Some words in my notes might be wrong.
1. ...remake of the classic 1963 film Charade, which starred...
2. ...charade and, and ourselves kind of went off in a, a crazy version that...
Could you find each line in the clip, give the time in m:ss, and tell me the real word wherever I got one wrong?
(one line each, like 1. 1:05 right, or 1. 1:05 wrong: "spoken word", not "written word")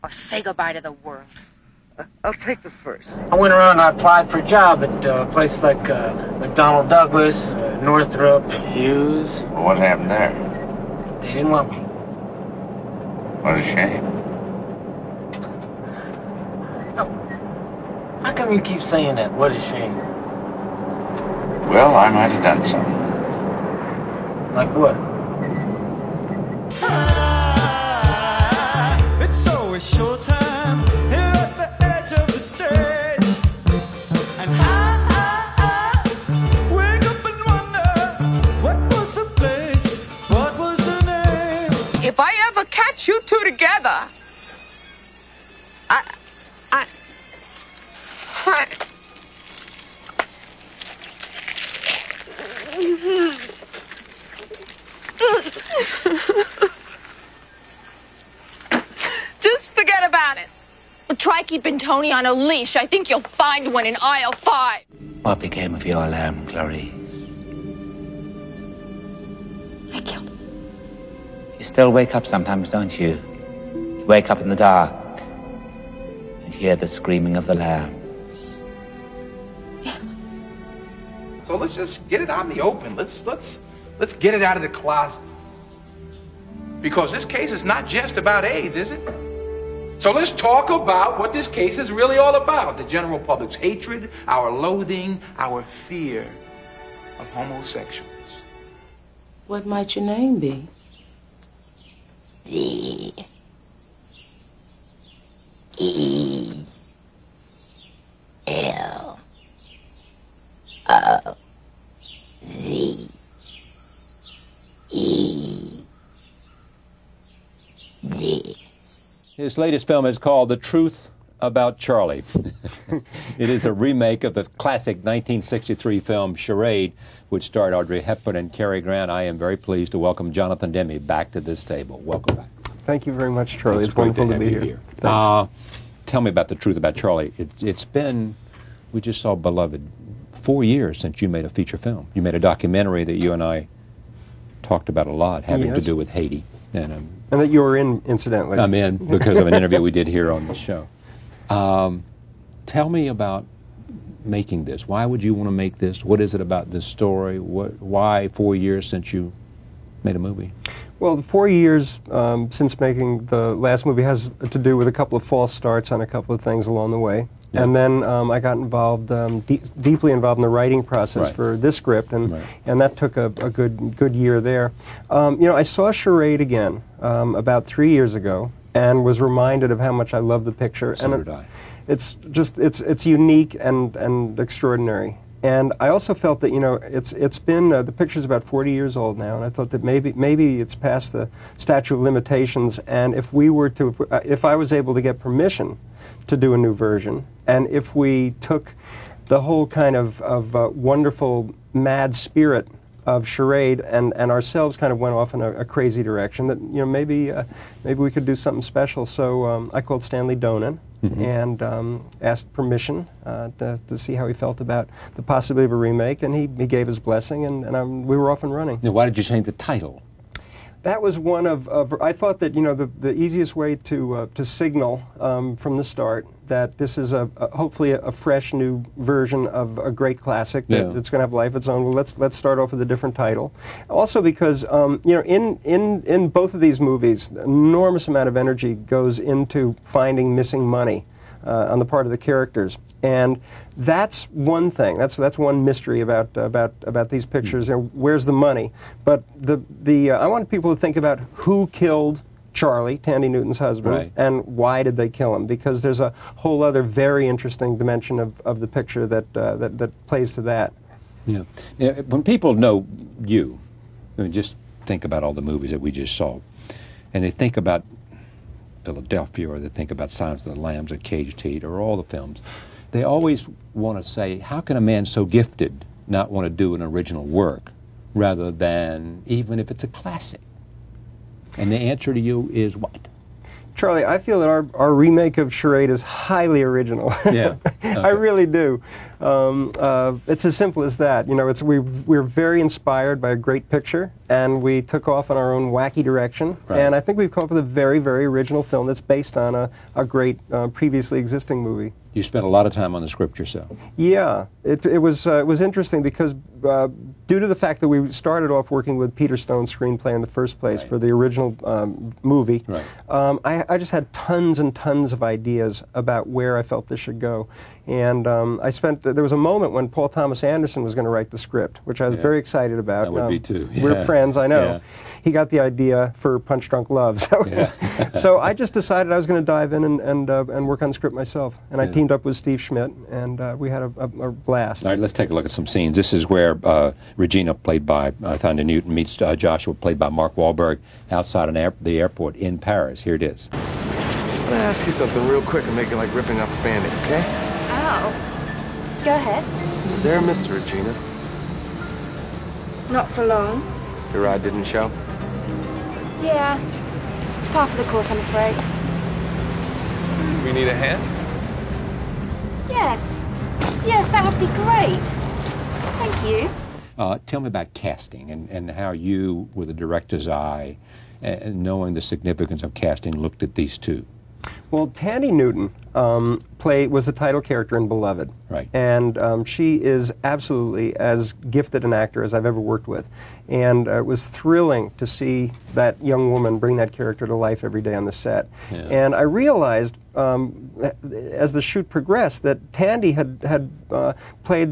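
1. 2:03 right
2. 3:23 wrong: "direction", not "version".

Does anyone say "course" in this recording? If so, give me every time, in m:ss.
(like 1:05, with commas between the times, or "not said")
5:57.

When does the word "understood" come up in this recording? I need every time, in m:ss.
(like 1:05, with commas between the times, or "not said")
not said.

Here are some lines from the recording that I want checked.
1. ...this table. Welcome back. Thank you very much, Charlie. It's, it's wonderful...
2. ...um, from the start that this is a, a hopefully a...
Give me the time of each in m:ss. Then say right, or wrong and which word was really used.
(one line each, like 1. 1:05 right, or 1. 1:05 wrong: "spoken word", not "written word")
1. 2:11 right
2. 3:45 right.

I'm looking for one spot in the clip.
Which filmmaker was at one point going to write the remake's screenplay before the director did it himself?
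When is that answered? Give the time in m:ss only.
5:19.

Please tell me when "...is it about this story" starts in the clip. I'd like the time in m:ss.
2:36.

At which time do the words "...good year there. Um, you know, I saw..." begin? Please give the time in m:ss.
2:53.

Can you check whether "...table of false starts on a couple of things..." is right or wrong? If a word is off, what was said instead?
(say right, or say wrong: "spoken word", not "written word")
wrong: "couple", not "table".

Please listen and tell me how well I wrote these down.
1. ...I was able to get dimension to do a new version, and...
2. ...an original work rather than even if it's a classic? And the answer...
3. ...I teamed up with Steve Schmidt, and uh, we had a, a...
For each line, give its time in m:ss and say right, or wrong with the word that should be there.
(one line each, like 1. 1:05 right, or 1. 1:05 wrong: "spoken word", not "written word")
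1. 3:14 wrong: "permission", not "dimension"
2. 4:36 right
3. 5:31 right.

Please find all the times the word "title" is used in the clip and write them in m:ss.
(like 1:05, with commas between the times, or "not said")
3:39, 3:53, 6:17.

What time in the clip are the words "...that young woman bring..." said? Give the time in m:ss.
6:25.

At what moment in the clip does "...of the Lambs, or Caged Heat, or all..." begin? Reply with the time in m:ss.
4:30.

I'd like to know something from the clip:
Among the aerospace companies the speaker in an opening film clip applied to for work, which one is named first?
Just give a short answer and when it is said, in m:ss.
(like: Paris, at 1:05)
McDonnell Douglas, at 0:06.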